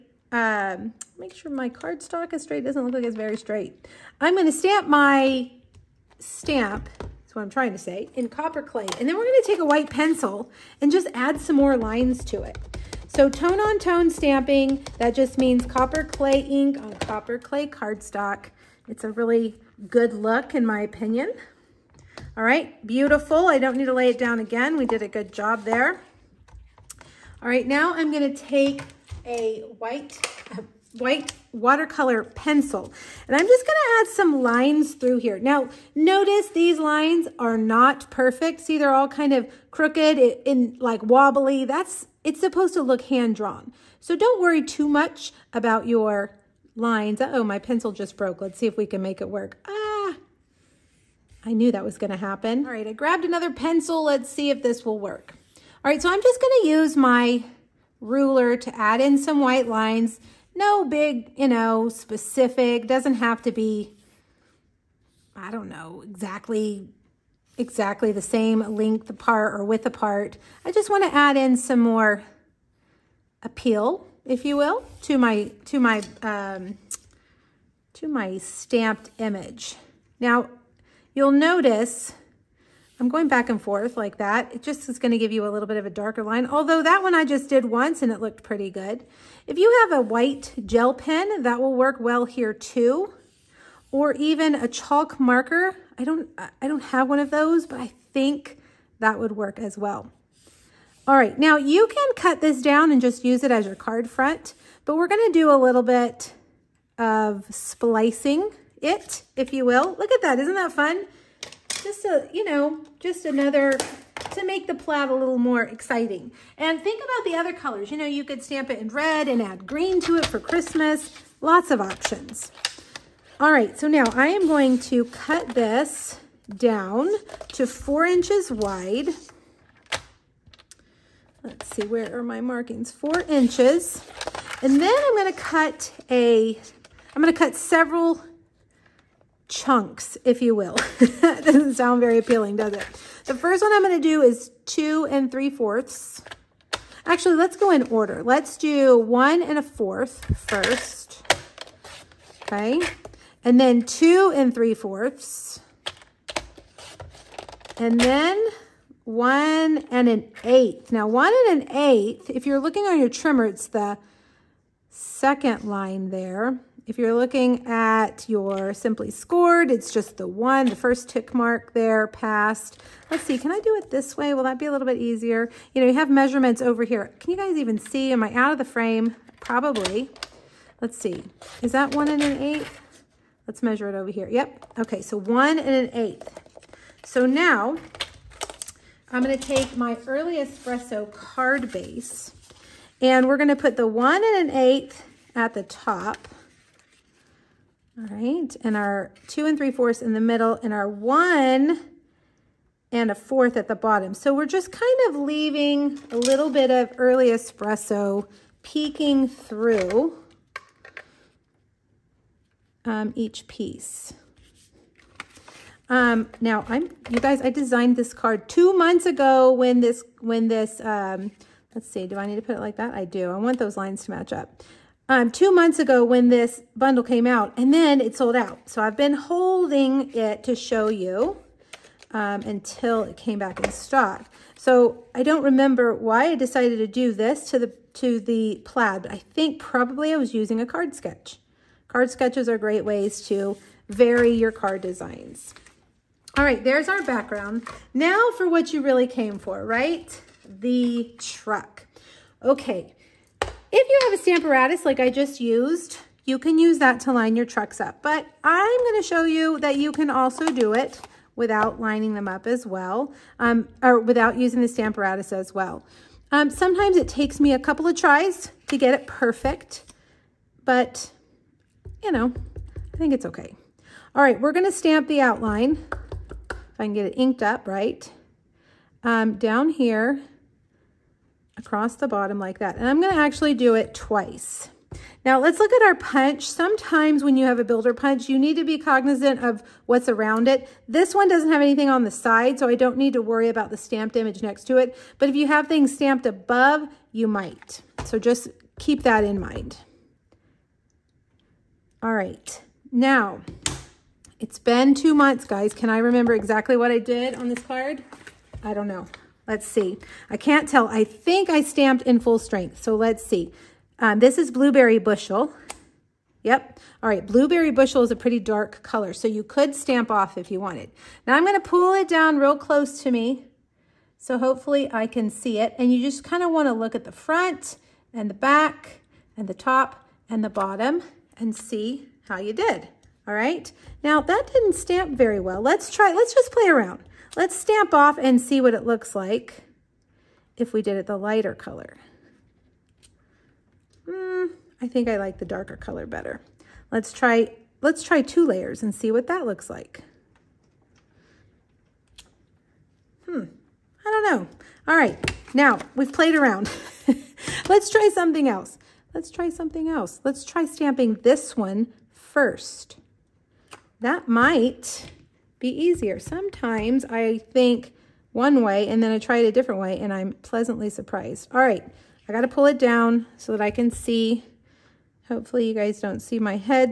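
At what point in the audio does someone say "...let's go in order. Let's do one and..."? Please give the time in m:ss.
2:27.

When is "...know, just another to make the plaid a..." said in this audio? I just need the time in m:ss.
1:52.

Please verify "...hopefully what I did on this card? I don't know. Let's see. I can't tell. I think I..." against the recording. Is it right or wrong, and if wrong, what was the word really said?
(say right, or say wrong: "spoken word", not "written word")
wrong: "exactly", not "hopefully".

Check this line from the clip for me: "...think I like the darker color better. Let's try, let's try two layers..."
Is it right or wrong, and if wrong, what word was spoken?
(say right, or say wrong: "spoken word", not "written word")
right.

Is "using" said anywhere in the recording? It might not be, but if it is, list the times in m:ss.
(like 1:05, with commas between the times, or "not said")
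4:00, 4:24.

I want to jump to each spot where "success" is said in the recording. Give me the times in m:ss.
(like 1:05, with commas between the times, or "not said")
not said.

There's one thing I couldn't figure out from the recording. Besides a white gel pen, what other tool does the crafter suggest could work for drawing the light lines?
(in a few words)
Chalk marker.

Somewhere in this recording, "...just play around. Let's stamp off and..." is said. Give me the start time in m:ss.
5:36.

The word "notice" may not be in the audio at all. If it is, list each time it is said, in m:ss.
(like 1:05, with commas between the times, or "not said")
0:35, 1:21.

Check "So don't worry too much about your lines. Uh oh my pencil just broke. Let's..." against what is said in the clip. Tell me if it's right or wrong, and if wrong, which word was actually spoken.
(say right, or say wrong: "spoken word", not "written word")
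right.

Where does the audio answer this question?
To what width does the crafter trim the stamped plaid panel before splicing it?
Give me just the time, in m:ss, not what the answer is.
2:07.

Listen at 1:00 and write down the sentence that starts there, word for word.
No big, you know, specific, doesn't have to be, I don't know, exactly exactly the same length apart or width apart.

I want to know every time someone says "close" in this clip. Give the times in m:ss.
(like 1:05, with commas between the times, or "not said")
5:22.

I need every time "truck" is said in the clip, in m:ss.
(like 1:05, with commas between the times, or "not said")
4:11, 4:17.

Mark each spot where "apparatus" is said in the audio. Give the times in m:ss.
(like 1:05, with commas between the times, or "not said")
4:14, 4:24.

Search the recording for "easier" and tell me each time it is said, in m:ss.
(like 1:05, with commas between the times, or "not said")
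2:54, 6:05.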